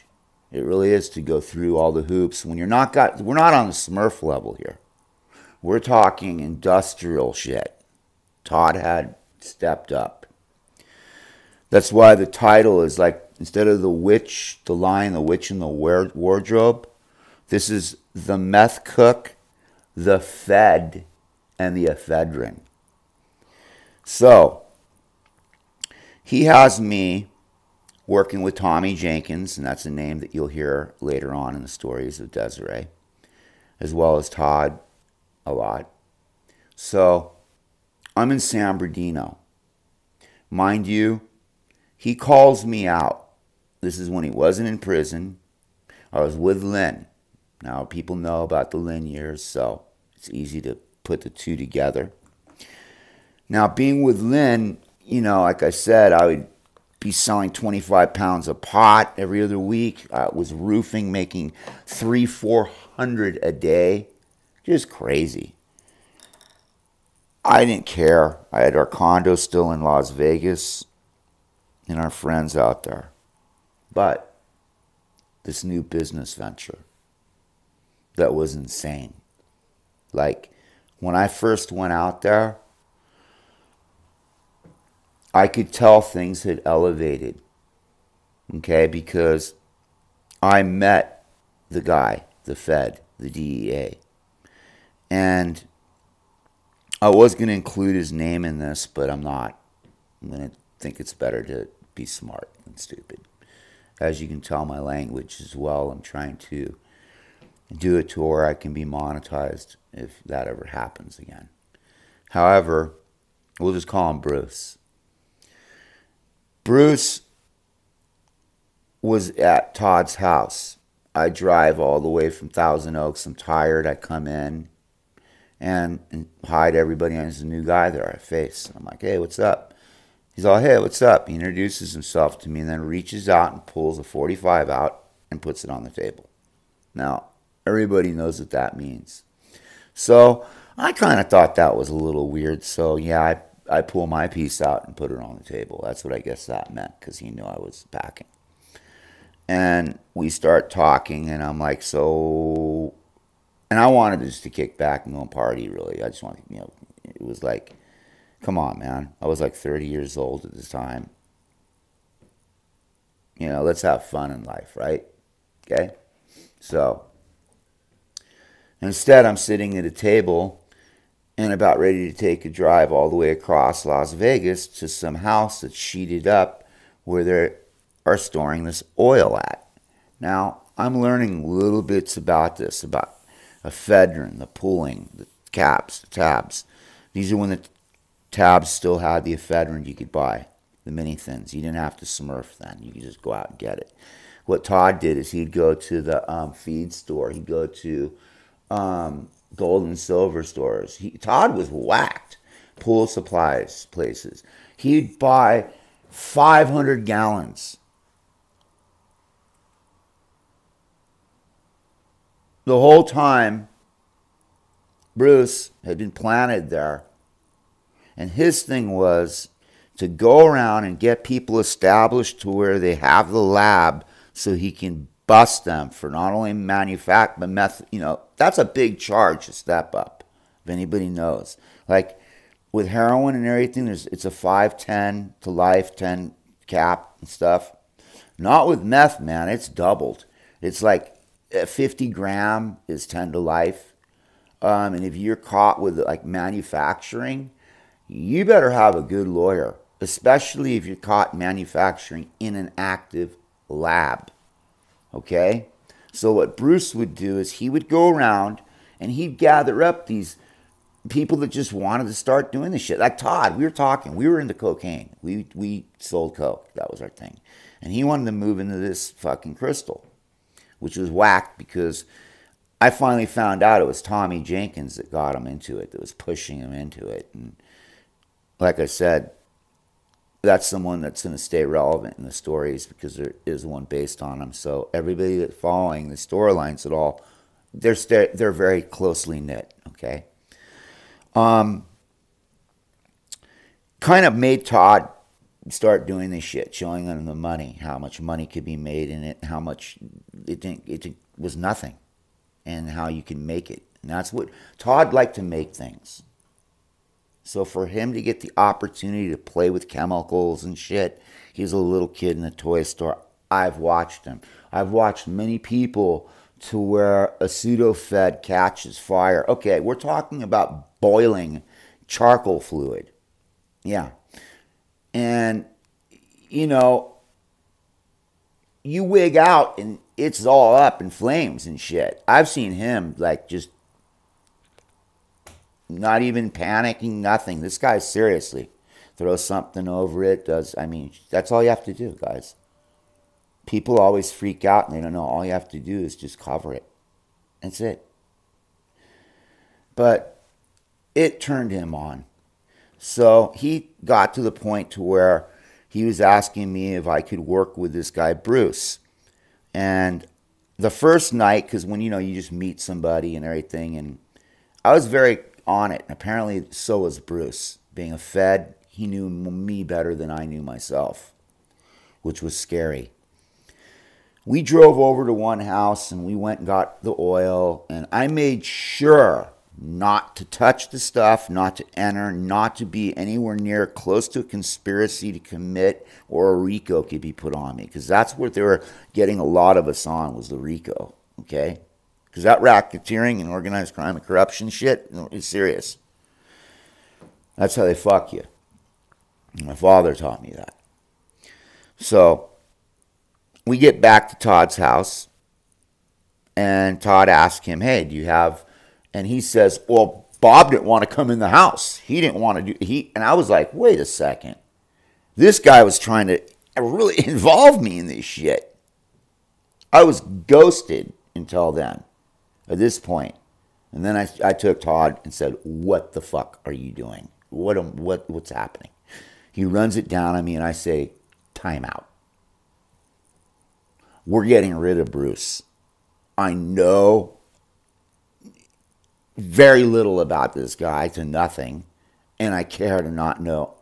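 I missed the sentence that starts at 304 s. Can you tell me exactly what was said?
And that's what Todd liked to make things.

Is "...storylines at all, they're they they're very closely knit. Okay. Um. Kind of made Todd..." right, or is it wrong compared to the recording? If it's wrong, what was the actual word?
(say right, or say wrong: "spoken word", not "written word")
right.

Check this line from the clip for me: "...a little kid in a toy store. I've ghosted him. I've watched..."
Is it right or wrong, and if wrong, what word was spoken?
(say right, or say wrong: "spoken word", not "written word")
wrong: "watched", not "ghosted".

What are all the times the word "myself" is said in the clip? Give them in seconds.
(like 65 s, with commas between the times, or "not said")
370 s.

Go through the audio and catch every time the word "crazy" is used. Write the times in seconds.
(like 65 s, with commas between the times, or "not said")
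64 s.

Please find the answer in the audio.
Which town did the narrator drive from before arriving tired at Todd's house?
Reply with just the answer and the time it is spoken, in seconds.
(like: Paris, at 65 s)
Thousand Oaks, at 122 s.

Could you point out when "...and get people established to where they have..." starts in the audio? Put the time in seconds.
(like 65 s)
220 s.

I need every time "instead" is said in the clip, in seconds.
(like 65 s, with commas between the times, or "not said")
13 s, 168 s.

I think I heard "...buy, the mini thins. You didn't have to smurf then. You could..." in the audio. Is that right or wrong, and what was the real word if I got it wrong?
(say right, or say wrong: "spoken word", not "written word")
right.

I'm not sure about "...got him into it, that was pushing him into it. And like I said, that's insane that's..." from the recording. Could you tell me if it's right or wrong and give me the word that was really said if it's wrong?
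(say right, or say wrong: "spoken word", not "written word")
wrong: "someone", not "insane".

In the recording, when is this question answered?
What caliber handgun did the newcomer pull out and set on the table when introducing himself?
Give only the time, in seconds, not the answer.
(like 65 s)
134 s.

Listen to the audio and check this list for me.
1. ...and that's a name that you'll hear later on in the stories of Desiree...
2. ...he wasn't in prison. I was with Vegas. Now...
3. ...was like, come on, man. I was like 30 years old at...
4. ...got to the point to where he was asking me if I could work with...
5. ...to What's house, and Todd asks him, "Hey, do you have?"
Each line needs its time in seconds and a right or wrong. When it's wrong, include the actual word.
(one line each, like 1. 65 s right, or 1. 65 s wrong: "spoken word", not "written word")
1. 29 s right
2. 44 s wrong: "Lynn", not "Vegas"
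3. 157 s right
4. 354 s right
5. 404 s wrong: "Todd", not "What".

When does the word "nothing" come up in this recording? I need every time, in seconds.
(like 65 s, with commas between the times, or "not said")
301 s, 337 s, 441 s.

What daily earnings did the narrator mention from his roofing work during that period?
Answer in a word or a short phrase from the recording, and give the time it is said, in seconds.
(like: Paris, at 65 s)
three, four hundred, at 61 s.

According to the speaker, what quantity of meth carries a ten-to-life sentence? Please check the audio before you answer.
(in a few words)
50 grams.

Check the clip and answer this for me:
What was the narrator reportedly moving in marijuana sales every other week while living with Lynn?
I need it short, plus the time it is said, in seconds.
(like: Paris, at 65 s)
25 pounds, at 57 s.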